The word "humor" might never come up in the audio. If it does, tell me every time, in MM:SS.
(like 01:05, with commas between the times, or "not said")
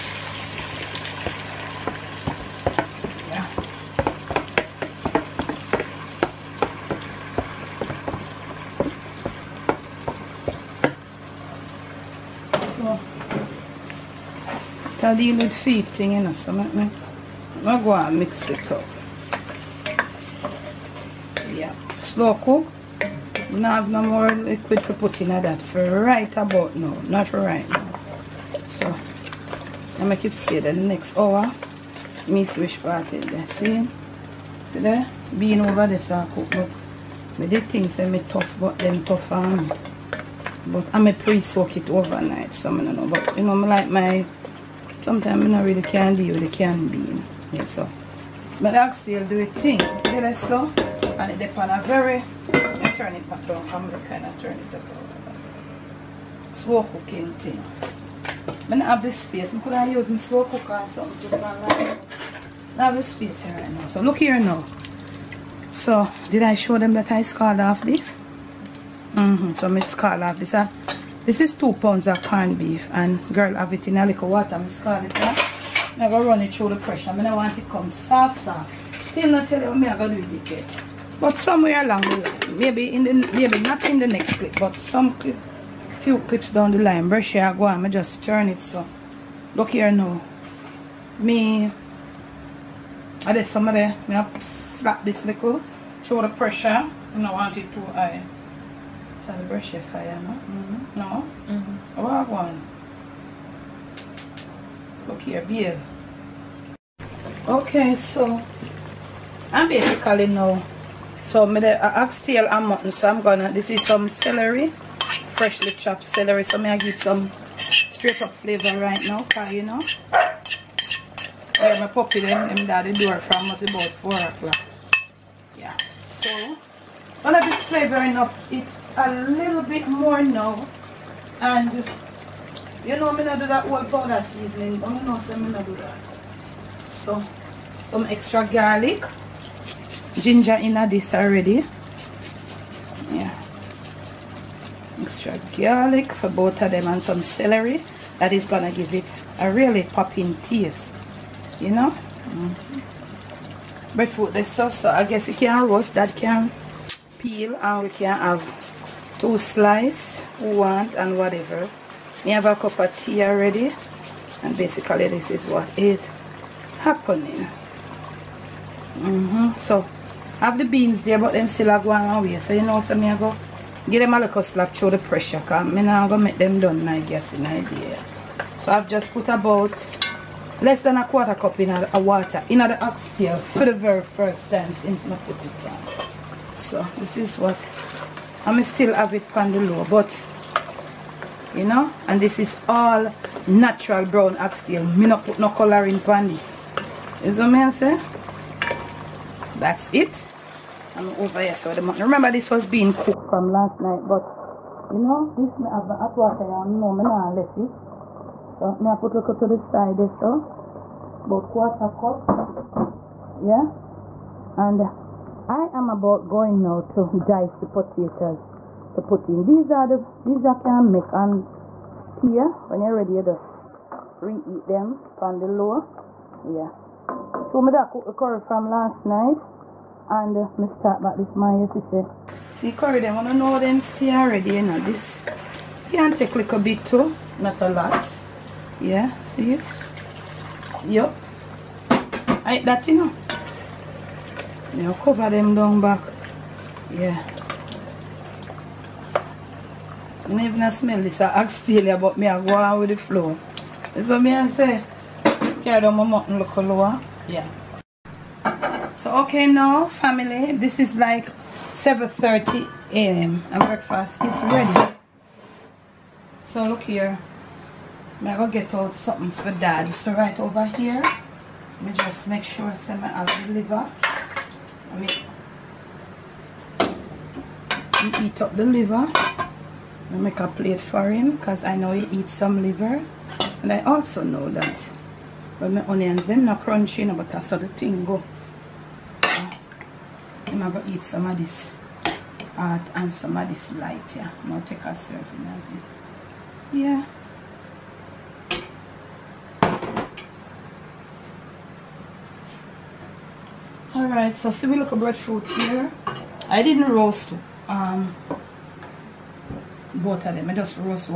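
not said.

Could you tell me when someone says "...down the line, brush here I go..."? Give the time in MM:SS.
01:26.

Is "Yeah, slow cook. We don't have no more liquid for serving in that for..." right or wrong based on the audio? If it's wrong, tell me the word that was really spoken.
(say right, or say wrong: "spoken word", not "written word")
wrong: "putting", not "serving".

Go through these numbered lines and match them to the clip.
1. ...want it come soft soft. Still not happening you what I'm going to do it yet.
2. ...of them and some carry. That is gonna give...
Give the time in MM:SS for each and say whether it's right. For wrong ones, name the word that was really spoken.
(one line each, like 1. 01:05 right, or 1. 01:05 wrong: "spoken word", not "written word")
1. 01:17 wrong: "telling", not "happening"
2. 02:26 wrong: "celery", not "carry".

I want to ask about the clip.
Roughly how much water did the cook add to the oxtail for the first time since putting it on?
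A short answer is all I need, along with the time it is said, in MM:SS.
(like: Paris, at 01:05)
less than a quarter cup, at 03:00.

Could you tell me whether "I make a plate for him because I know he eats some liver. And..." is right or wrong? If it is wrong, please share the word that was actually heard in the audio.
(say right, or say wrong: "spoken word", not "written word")
right.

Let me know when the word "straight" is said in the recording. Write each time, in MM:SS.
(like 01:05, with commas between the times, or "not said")
01:57.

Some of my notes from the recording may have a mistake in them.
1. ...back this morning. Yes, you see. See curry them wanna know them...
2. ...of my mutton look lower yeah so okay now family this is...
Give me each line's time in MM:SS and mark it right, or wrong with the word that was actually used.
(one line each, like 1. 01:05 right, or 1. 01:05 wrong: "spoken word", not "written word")
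1. 03:51 right
2. 04:15 right.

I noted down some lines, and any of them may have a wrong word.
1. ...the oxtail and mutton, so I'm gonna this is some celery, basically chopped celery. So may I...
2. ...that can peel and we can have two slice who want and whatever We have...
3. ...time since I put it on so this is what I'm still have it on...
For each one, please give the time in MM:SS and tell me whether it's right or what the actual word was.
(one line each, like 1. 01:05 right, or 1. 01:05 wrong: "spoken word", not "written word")
1. 01:51 wrong: "freshly", not "basically"
2. 02:35 right
3. 03:04 right.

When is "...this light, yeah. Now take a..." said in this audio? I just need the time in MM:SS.
04:53.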